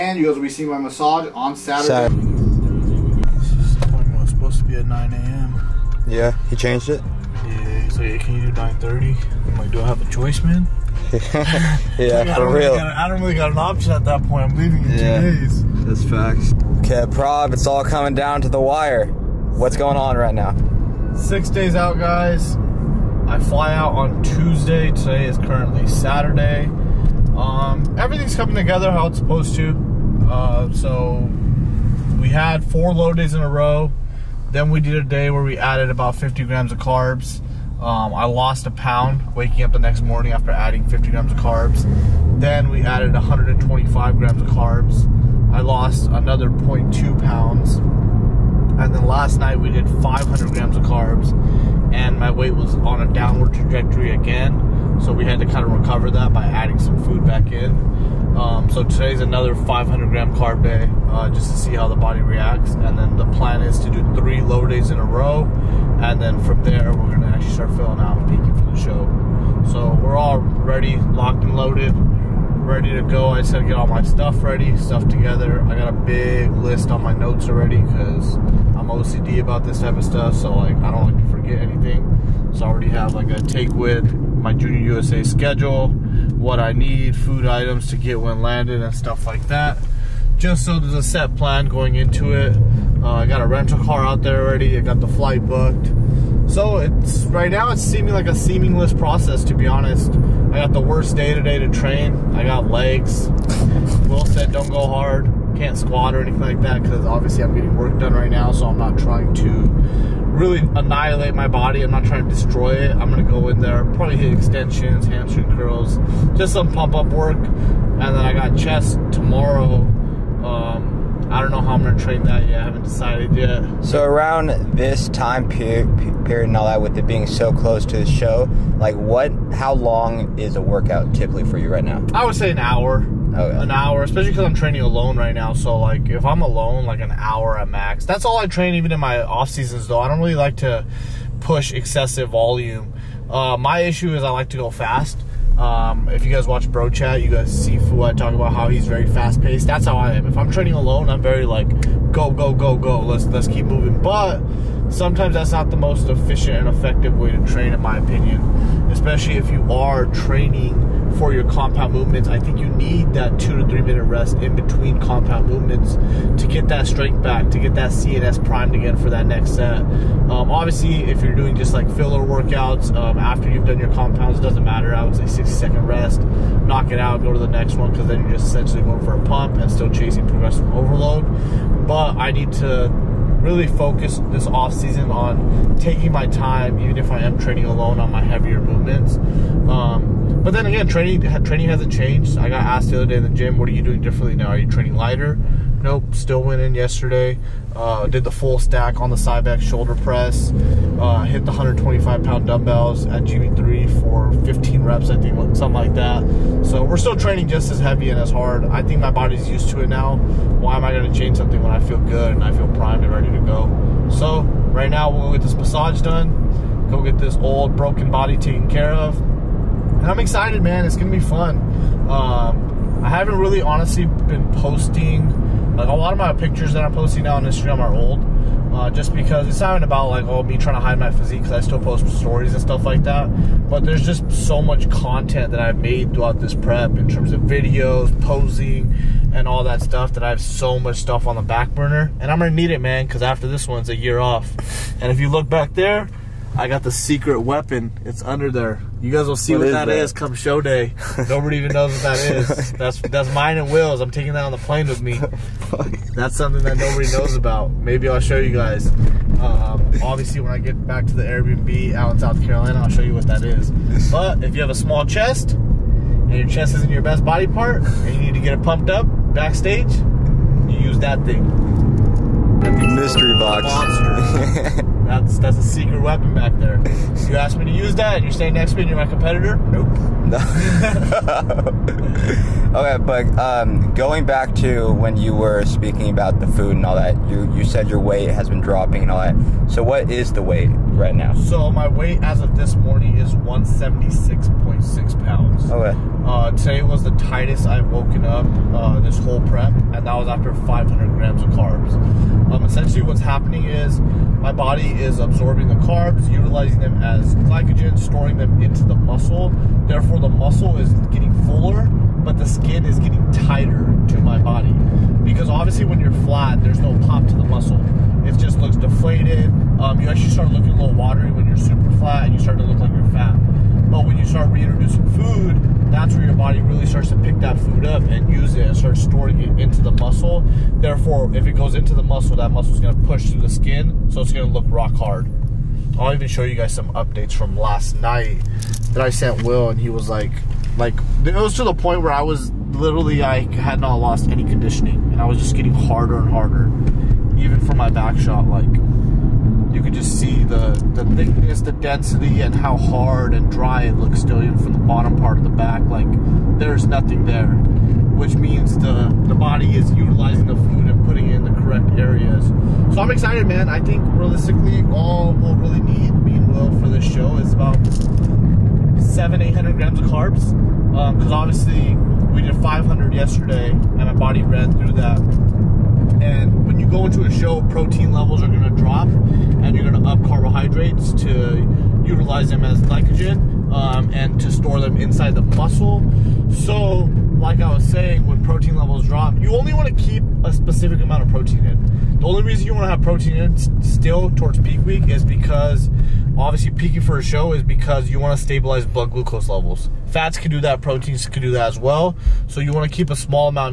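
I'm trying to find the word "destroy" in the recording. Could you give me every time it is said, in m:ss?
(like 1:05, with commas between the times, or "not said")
1:52.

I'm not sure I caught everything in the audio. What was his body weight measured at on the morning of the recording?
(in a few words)
176.6 pounds.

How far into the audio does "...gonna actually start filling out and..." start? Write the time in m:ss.
1:07.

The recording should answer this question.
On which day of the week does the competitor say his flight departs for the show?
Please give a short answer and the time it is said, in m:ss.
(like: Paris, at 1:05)
Tuesday, at 0:24.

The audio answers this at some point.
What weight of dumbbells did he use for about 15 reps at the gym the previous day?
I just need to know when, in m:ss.
3:21.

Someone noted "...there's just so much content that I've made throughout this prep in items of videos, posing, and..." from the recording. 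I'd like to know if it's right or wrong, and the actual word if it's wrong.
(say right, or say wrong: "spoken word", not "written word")
wrong: "terms", not "items".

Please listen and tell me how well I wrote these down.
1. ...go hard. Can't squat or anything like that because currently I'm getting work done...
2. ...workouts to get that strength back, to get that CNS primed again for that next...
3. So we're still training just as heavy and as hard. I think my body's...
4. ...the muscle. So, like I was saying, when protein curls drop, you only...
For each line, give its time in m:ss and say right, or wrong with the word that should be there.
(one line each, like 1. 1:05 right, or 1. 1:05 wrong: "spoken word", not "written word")
1. 1:44 wrong: "obviously", not "currently"
2. 2:45 wrong: "movements", not "workouts"
3. 3:26 right
4. 6:25 wrong: "levels", not "curls".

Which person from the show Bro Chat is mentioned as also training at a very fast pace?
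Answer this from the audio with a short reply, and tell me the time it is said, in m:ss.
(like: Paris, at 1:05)
Fouad, at 2:27.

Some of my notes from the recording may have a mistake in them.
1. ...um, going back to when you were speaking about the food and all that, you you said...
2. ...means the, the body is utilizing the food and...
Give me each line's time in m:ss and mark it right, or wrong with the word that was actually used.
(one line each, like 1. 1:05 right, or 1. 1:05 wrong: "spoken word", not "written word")
1. 4:43 right
2. 5:58 right.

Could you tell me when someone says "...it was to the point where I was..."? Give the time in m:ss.
5:41.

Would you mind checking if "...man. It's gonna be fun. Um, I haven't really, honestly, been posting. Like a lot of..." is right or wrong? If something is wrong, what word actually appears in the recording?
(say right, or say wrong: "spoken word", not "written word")
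right.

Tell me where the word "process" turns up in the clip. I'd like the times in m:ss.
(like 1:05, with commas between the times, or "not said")
1:38.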